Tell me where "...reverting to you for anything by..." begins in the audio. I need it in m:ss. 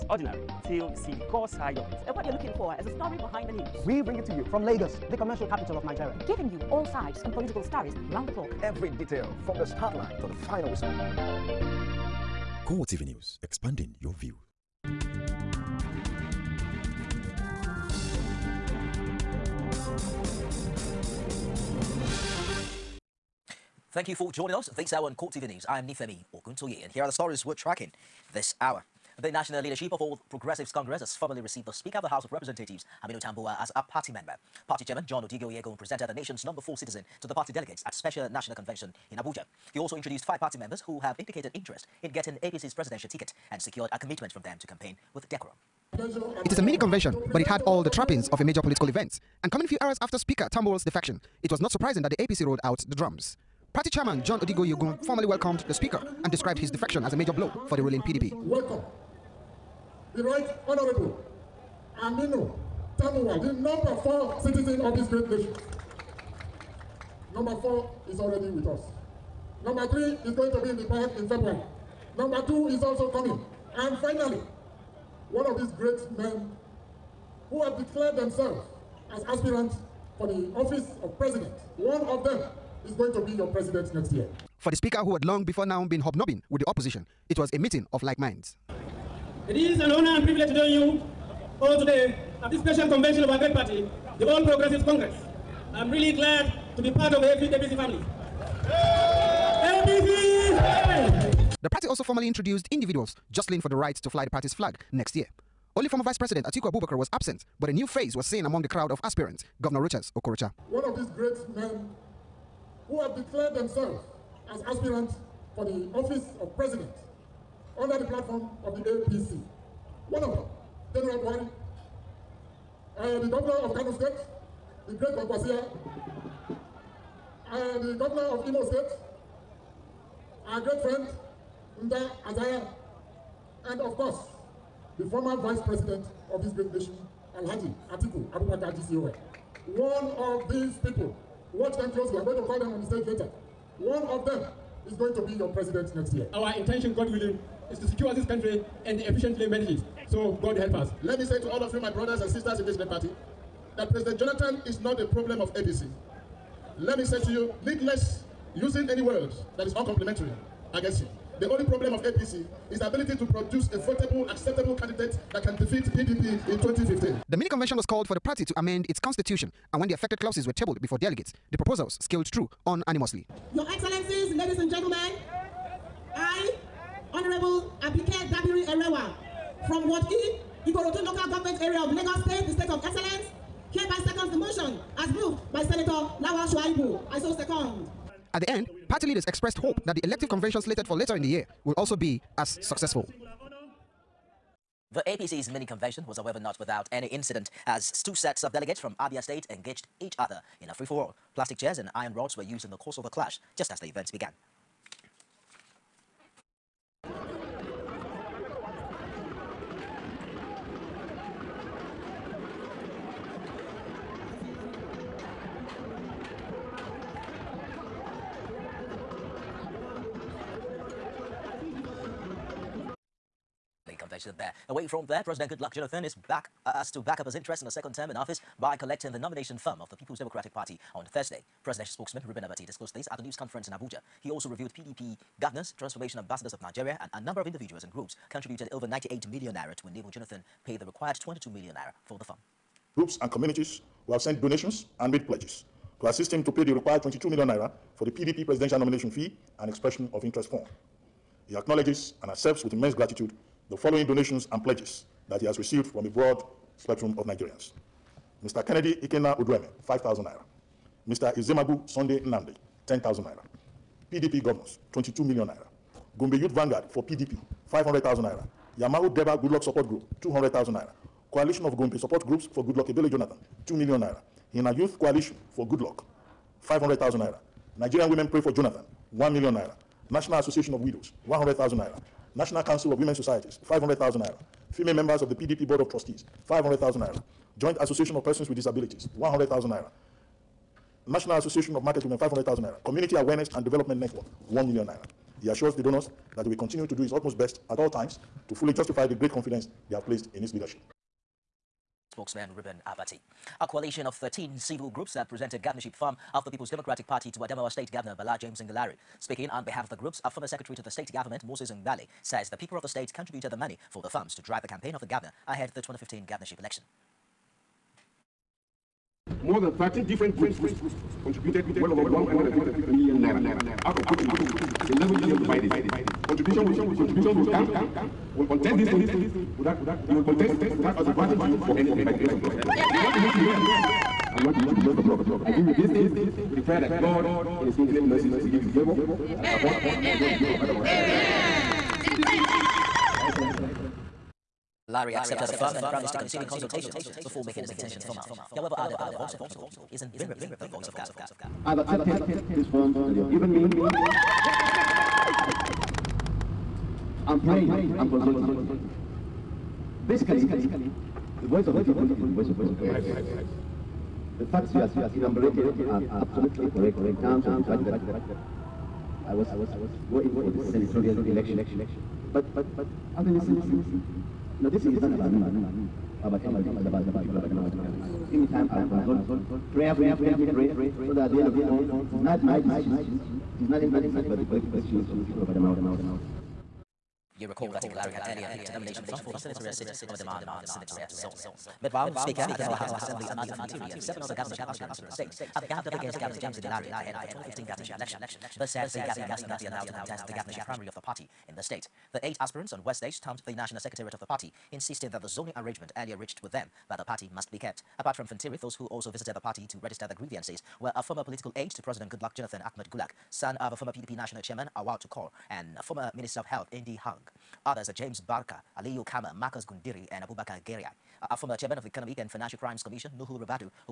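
5:31.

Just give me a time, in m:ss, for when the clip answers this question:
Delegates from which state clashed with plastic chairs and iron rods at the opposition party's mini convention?
3:19.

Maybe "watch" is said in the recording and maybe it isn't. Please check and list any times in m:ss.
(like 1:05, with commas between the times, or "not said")
2:21.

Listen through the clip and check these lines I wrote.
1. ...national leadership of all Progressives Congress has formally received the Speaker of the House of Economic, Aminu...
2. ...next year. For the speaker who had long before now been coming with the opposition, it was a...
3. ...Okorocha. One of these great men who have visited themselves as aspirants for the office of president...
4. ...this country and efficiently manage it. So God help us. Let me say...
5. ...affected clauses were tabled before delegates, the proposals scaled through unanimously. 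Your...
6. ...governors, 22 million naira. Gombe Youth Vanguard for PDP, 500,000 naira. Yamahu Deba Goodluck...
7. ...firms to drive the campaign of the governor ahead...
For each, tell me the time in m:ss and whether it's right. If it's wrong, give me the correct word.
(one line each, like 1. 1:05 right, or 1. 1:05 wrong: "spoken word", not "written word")
1. 0:29 wrong: "Representatives", not "Economic"
2. 1:23 wrong: "hobnobbing", not "coming"
3. 1:50 wrong: "declared", not "visited"
4. 2:28 right
5. 2:49 right
6. 4:24 right
7. 5:14 right.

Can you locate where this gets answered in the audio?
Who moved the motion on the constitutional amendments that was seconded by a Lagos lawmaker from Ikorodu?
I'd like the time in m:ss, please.
3:05.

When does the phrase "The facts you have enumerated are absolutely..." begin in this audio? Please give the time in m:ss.
6:04.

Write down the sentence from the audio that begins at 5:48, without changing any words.
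He, however, added that the voice of the people is invariably the voice of God.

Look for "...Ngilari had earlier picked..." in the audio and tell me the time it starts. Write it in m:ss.
6:27.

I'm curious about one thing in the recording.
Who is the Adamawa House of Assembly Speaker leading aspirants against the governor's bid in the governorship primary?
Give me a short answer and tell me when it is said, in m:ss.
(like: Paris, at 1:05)
Amadu Fintiri, at 6:33.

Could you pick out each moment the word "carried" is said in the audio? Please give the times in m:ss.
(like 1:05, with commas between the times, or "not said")
not said.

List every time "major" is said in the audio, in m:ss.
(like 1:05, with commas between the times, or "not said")
0:48, 0:57.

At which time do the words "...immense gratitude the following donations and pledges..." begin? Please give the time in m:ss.
4:12.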